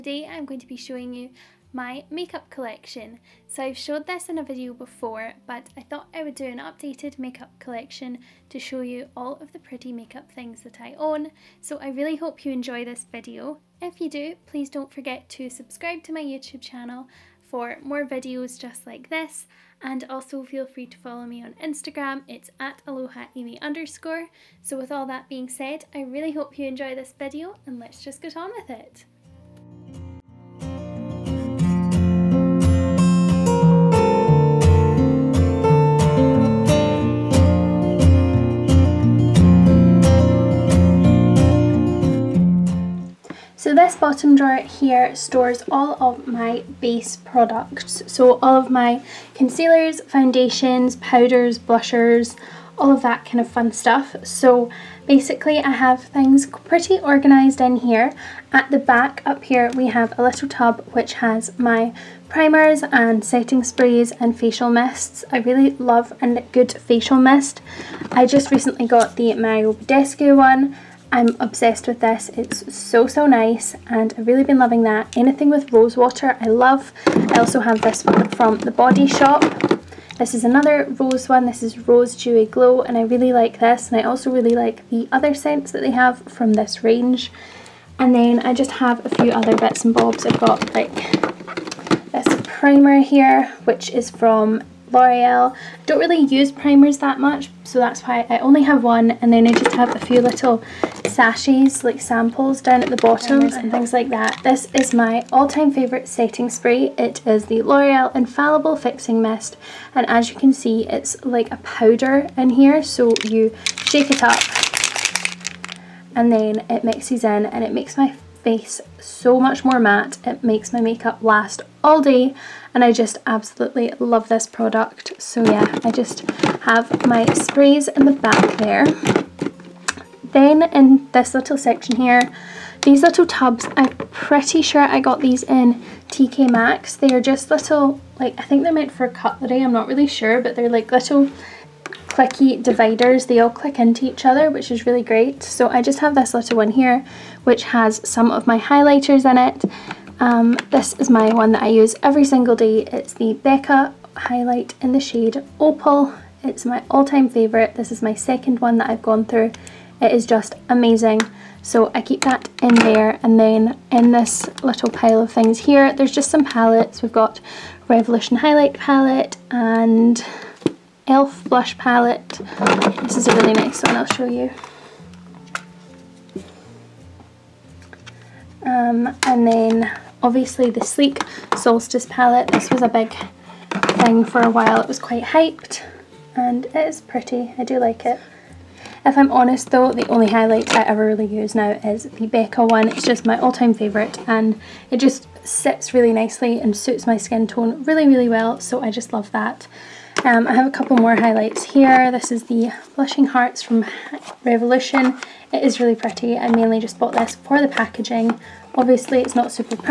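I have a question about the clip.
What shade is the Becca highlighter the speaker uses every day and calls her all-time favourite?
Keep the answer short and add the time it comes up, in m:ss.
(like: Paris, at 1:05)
Opal, at 2:35.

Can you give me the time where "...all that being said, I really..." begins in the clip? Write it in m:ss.
0:24.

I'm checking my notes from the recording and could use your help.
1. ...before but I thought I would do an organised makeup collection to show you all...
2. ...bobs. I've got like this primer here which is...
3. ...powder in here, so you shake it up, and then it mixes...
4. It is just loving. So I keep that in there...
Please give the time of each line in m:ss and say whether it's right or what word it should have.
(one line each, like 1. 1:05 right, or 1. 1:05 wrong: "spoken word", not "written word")
1. 0:04 wrong: "updated", not "organised"
2. 1:29 right
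3. 1:51 right
4. 2:40 wrong: "amazing", not "loving".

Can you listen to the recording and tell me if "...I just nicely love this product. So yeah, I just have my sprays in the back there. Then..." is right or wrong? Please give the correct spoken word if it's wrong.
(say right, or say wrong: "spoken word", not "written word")
wrong: "absolutely", not "nicely".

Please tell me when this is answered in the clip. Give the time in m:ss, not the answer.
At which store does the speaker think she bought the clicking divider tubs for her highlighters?
2:16.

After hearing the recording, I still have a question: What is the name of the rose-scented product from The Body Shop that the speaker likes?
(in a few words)
Rose Dewy Glow.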